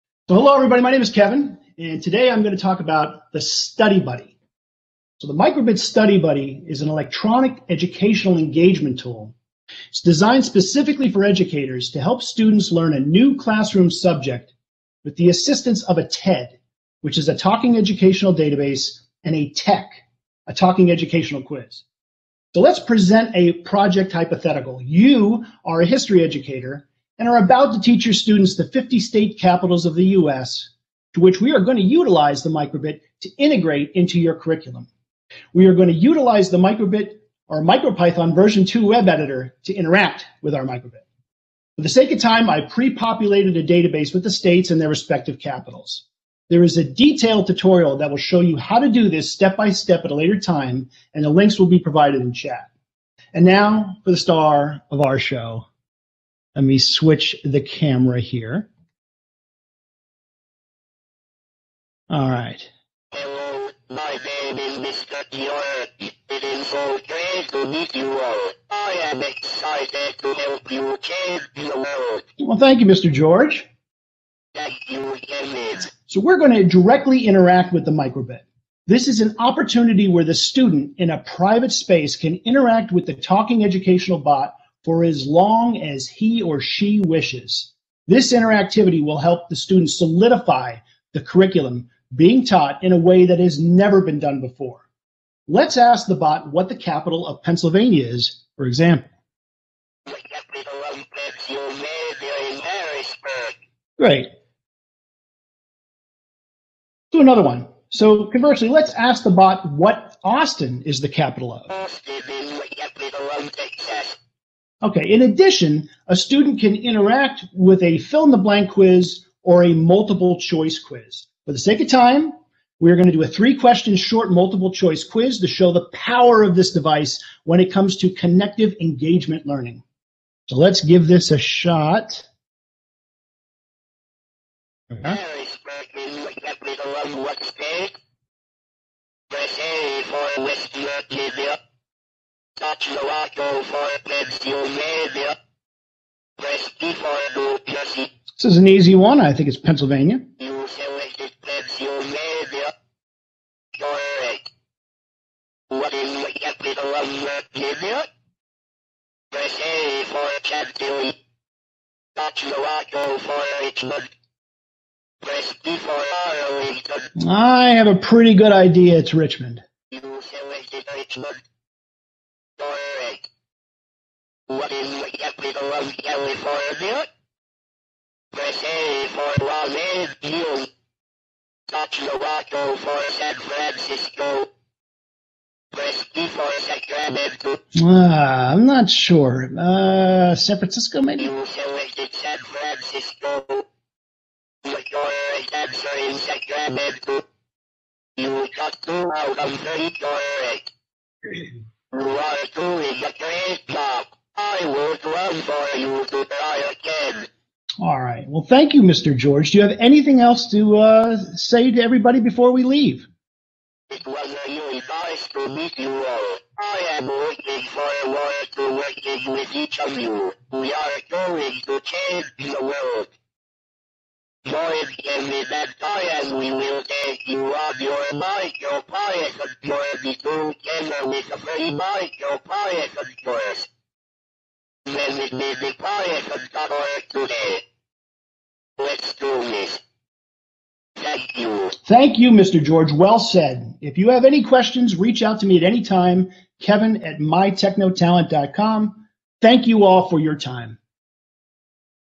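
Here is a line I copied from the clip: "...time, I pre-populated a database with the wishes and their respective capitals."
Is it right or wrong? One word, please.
wrong.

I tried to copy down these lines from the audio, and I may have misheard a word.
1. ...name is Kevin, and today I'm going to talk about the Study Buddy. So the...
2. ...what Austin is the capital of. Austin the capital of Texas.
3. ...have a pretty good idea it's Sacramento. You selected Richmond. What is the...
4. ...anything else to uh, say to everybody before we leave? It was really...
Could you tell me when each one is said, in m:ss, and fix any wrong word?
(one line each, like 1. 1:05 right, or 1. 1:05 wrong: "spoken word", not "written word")
1. 0:00 right
2. 1:49 right
3. 2:47 wrong: "Richmond", not "Sacramento"
4. 3:29 right.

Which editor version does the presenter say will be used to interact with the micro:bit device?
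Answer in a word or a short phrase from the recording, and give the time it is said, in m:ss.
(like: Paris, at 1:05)
Version 2, at 0:38.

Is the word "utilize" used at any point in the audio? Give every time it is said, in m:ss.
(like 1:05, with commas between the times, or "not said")
0:31, 0:35.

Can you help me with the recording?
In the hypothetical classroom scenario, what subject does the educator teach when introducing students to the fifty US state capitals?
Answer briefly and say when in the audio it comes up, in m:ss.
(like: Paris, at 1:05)
History, at 0:25.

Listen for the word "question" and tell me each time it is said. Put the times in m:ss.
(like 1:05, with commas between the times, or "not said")
2:03, 4:04.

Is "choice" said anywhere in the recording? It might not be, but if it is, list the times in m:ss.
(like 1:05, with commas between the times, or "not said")
2:00, 2:04.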